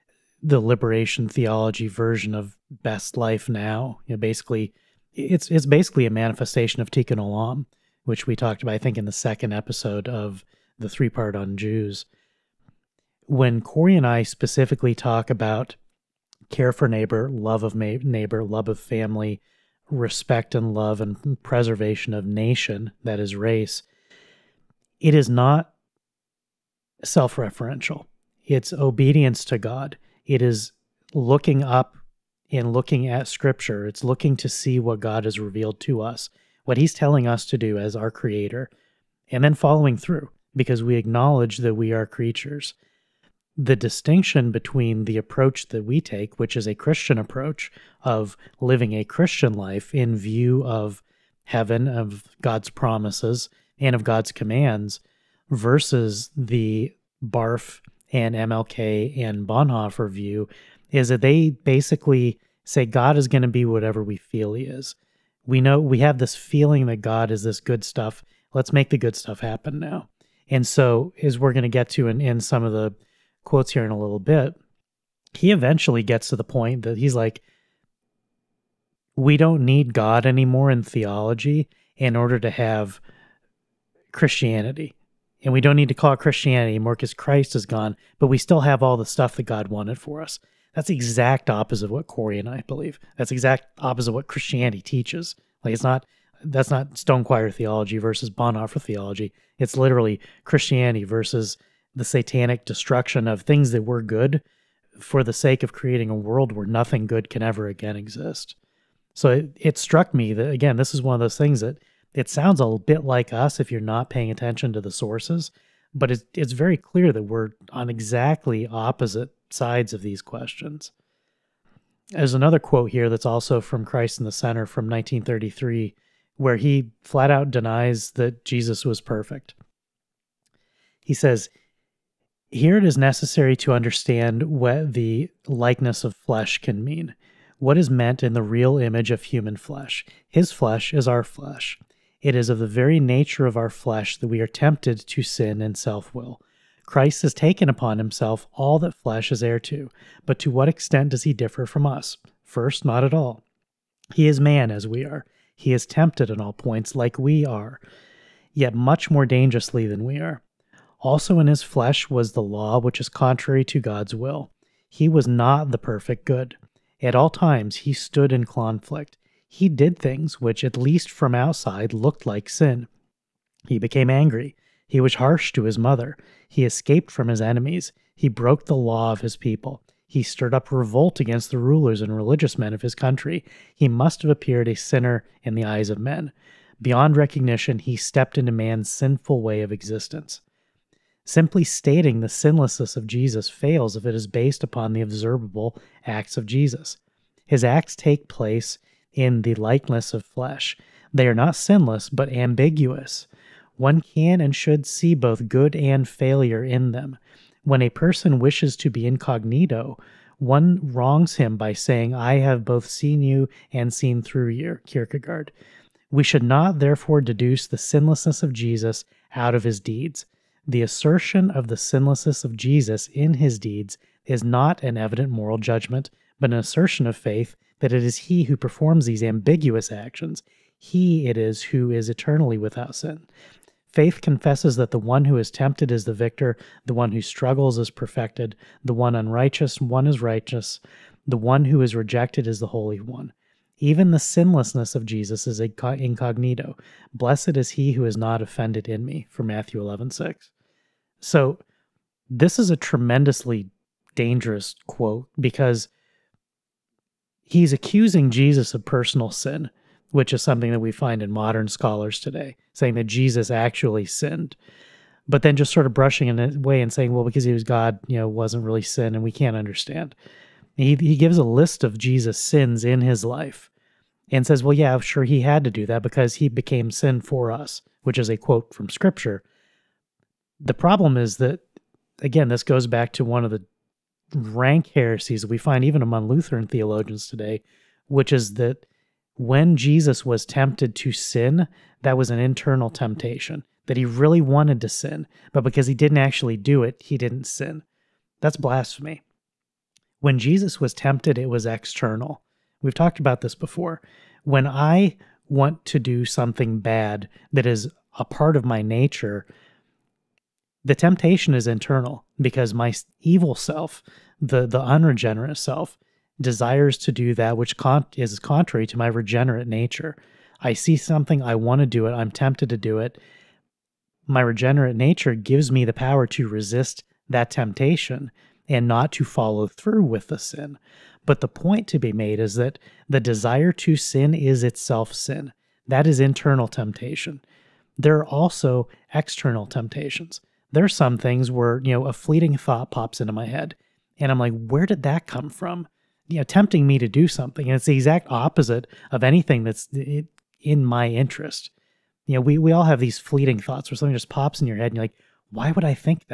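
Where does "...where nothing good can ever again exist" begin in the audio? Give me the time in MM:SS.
01:46.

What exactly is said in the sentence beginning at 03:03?
He must have appeared a sinner in the eyes of men.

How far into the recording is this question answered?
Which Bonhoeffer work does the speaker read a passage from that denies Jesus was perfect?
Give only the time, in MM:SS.
02:03.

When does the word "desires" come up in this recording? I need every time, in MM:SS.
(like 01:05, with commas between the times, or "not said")
05:16, 05:33.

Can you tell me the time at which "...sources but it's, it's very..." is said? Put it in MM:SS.
01:54.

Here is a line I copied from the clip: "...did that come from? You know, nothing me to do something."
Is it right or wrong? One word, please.
wrong.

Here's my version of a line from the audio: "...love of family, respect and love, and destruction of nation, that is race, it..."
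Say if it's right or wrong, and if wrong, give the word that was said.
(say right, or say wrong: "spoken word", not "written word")
wrong: "preservation", not "destruction".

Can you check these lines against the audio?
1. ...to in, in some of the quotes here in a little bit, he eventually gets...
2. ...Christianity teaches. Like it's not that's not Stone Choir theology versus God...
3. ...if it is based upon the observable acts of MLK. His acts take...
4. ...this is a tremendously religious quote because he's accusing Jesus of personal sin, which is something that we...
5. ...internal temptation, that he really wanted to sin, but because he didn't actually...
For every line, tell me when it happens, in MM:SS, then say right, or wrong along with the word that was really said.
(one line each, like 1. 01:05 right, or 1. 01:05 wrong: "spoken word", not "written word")
1. 01:11 right
2. 01:34 wrong: "Bonhoeffer", not "God"
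3. 03:13 wrong: "Jesus", not "MLK"
4. 04:12 wrong: "dangerous", not "religious"
5. 04:52 right.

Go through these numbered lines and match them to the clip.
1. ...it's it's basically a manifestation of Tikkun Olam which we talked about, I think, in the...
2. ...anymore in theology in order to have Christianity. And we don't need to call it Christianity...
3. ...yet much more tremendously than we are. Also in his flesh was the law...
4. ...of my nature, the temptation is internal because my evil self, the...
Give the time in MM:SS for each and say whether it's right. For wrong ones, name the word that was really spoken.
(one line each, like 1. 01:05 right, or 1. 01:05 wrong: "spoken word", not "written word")
1. 00:05 right
2. 01:20 right
3. 02:38 wrong: "dangerously", not "tremendously"
4. 05:08 right.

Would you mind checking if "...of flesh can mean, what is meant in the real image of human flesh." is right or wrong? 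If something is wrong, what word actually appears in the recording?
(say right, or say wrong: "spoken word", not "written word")
right.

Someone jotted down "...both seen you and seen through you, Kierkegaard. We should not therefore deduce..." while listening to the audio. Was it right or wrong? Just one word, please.
right.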